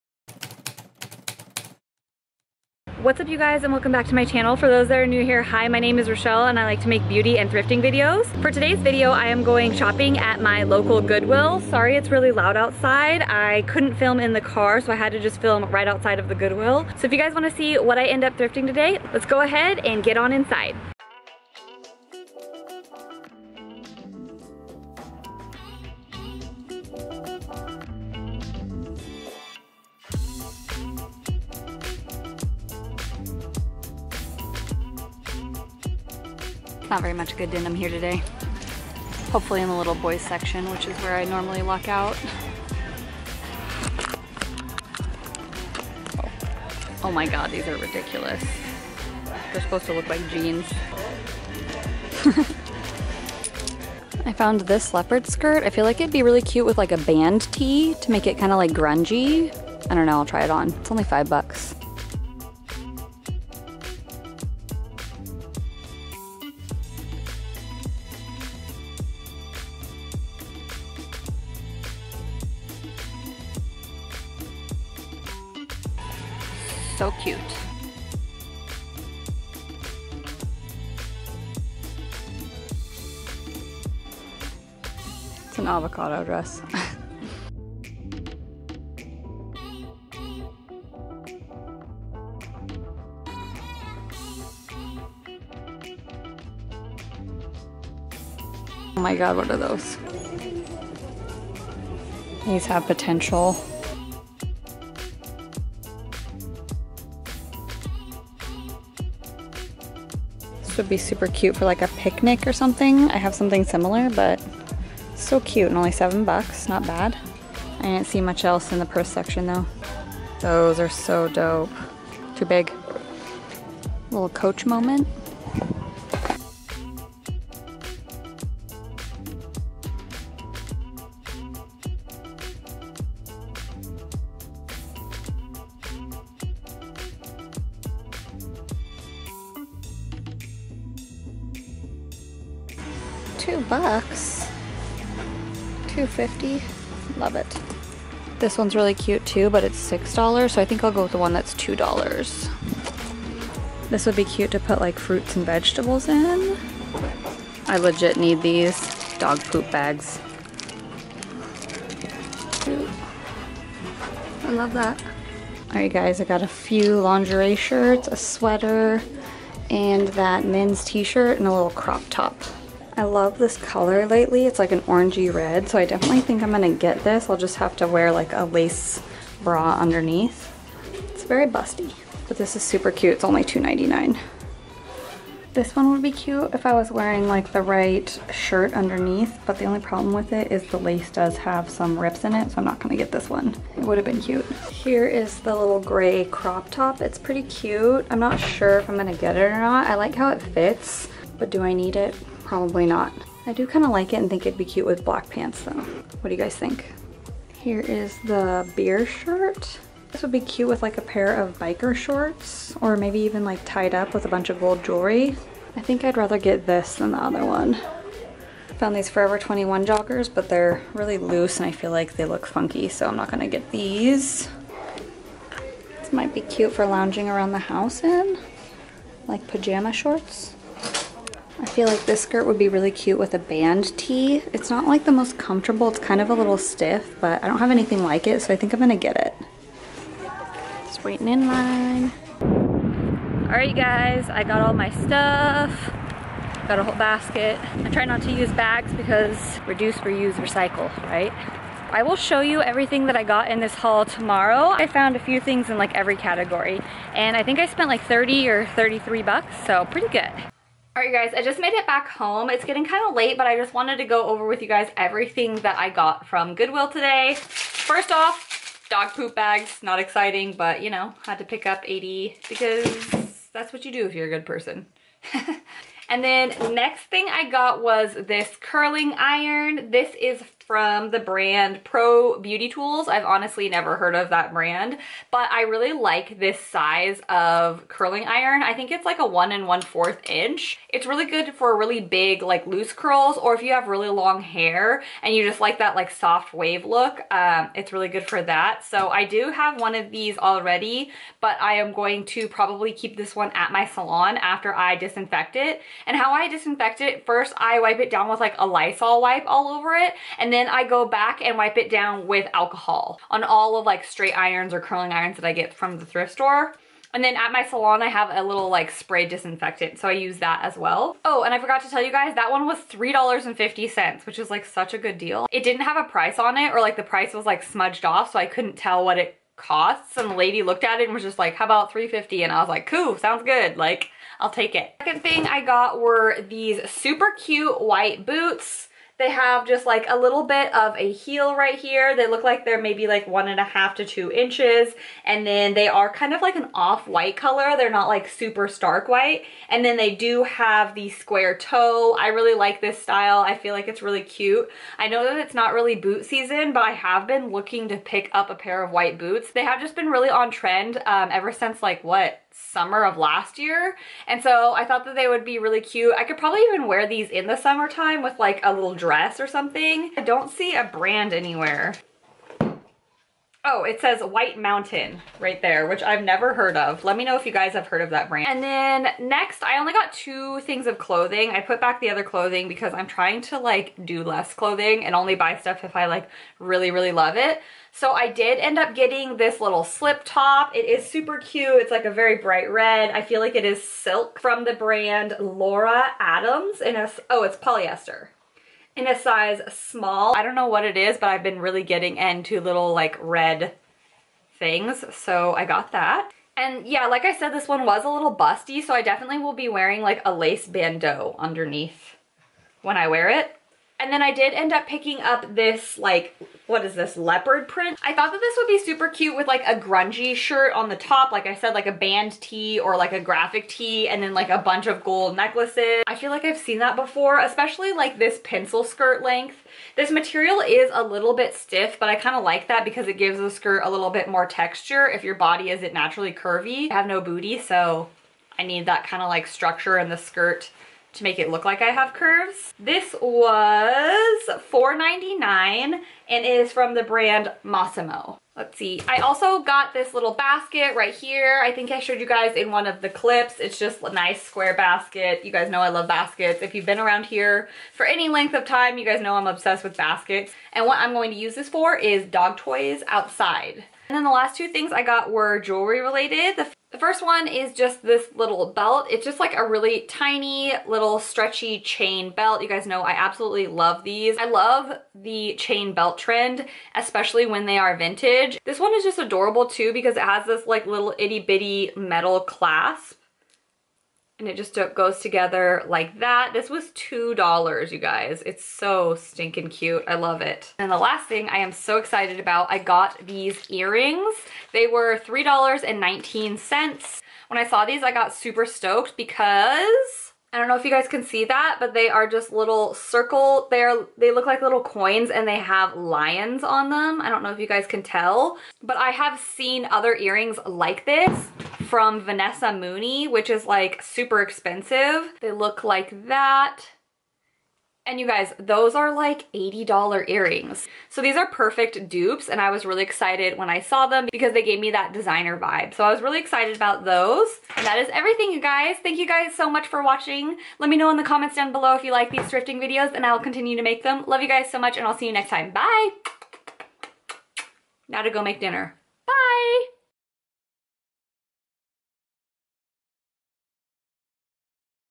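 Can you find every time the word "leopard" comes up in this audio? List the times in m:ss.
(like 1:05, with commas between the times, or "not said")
0:54, 6:57.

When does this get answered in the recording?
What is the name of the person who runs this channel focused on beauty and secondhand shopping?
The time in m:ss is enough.
0:06.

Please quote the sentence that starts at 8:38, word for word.
And you guys, those are like $80 earrings.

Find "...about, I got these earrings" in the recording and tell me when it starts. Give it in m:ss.
8:12.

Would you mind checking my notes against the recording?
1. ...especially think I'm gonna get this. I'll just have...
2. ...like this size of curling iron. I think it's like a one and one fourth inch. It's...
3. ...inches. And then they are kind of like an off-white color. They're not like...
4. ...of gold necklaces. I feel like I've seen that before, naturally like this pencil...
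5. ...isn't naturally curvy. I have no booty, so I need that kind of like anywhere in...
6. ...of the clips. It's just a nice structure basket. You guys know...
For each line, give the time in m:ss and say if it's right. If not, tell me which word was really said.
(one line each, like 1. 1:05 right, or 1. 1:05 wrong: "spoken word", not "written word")
1. 2:55 wrong: "definitely", not "especially"
2. 4:45 right
3. 5:44 right
4. 7:04 wrong: "especially", not "naturally"
5. 7:15 wrong: "structure", not "anywhere"
6. 7:32 wrong: "square", not "structure".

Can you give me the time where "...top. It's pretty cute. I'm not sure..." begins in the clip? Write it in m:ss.
3:16.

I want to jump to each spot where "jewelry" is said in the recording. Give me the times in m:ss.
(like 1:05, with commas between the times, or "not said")
3:34, 7:45.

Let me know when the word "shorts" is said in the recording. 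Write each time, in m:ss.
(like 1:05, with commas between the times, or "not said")
3:31, 3:49.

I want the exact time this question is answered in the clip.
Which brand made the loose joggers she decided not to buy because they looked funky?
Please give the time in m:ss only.
3:39.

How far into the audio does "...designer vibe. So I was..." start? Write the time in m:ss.
8:45.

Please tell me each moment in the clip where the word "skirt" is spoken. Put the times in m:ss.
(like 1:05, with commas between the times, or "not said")
0:55, 3:52, 7:08, 7:13, 7:20.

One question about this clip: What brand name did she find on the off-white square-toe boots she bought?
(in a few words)
White Mountain.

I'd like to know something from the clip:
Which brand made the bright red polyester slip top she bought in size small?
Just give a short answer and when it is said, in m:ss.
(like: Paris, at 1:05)
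Laura Adams, at 6:35.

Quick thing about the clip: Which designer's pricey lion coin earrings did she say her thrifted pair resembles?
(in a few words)
Vanessa Mooney.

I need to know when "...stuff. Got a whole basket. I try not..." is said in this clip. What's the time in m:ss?
4:04.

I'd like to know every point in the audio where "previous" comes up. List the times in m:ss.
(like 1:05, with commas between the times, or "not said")
not said.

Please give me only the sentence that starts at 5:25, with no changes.
It didn't have a price on it, or like the price was like smudged off, so I couldn't tell what it costs.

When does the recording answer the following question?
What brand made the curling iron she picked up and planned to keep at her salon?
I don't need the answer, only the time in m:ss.
4:41.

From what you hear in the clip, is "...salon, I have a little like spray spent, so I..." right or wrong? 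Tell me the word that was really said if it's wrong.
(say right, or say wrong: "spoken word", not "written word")
wrong: "disinfectant", not "spent".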